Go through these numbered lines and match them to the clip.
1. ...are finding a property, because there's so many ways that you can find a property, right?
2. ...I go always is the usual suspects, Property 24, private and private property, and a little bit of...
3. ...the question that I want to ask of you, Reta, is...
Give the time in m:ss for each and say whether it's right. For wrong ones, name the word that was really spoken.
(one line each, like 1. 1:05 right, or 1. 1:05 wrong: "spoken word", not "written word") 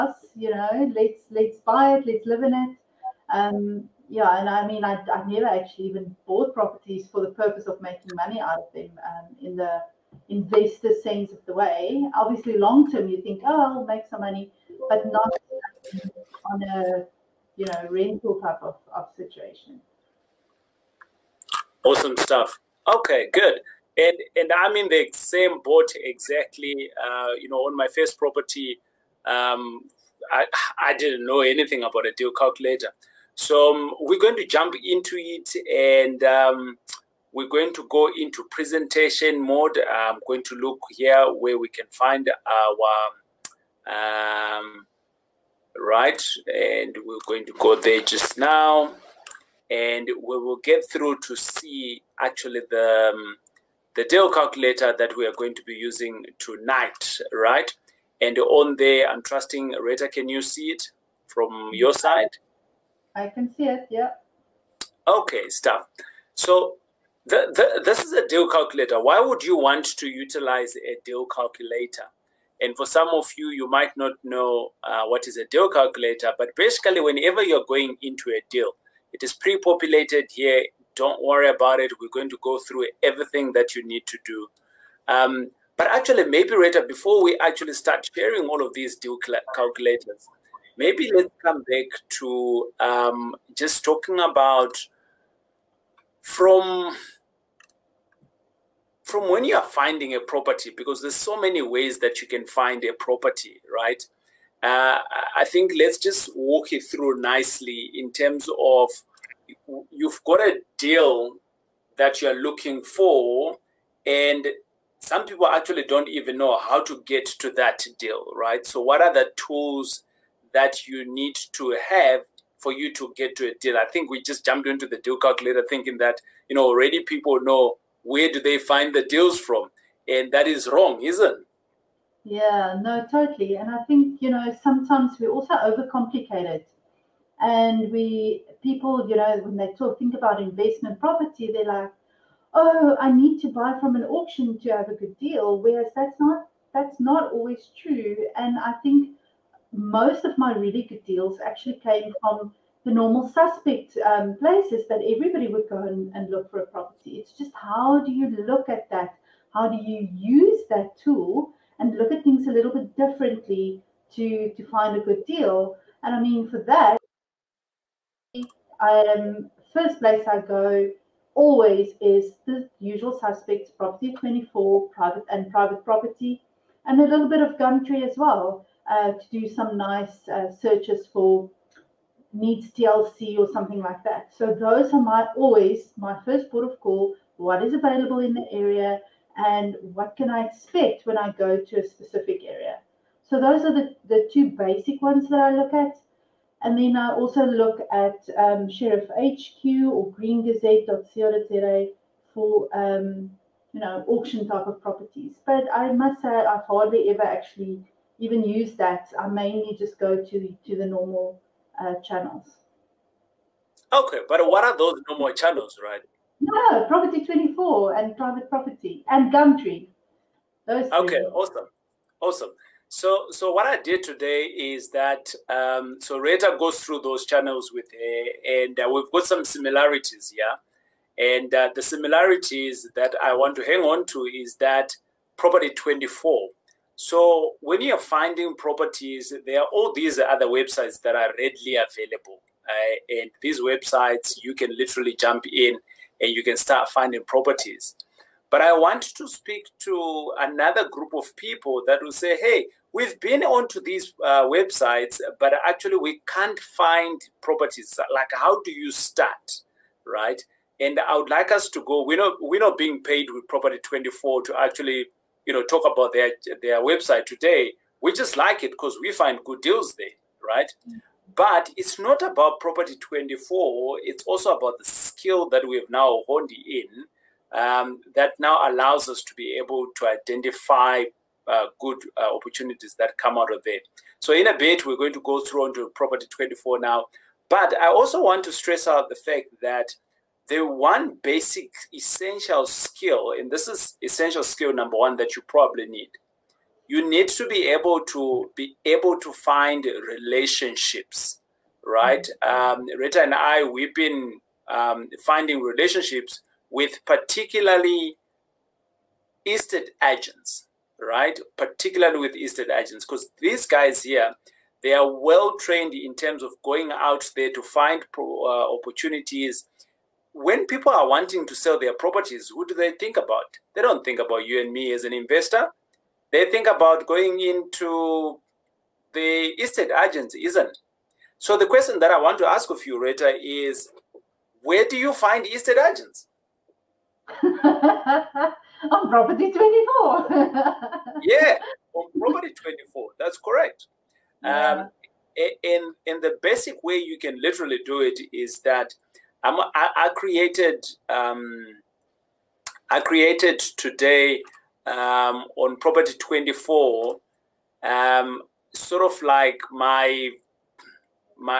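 1. 1:39 right
2. 2:50 right
3. 5:31 wrong: "Rita", not "Reta".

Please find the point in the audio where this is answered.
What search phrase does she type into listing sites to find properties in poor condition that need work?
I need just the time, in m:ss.
3:02.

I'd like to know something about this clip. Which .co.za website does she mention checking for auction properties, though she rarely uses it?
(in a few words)
greengazette.co.za.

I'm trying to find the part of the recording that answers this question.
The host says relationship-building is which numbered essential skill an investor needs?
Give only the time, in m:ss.
4:54.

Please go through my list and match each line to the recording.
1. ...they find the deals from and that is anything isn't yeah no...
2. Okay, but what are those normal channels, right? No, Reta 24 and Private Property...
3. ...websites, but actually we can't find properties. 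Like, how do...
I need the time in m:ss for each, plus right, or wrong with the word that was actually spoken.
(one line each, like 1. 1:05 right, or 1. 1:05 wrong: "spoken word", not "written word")
1. 2:08 wrong: "wrong", not "anything"
2. 3:33 wrong: "Property", not "Reta"
3. 4:14 right.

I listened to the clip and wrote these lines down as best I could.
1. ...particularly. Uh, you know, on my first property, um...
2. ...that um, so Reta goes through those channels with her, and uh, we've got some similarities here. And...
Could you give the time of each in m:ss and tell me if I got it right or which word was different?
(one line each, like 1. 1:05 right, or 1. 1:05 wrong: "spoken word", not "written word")
1. 0:25 wrong: "exactly", not "particularly"
2. 3:44 right.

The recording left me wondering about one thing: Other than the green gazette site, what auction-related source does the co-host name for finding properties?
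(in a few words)
Sheriff HQ.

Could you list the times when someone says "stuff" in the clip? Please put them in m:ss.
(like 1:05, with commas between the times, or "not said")
0:22, 1:05.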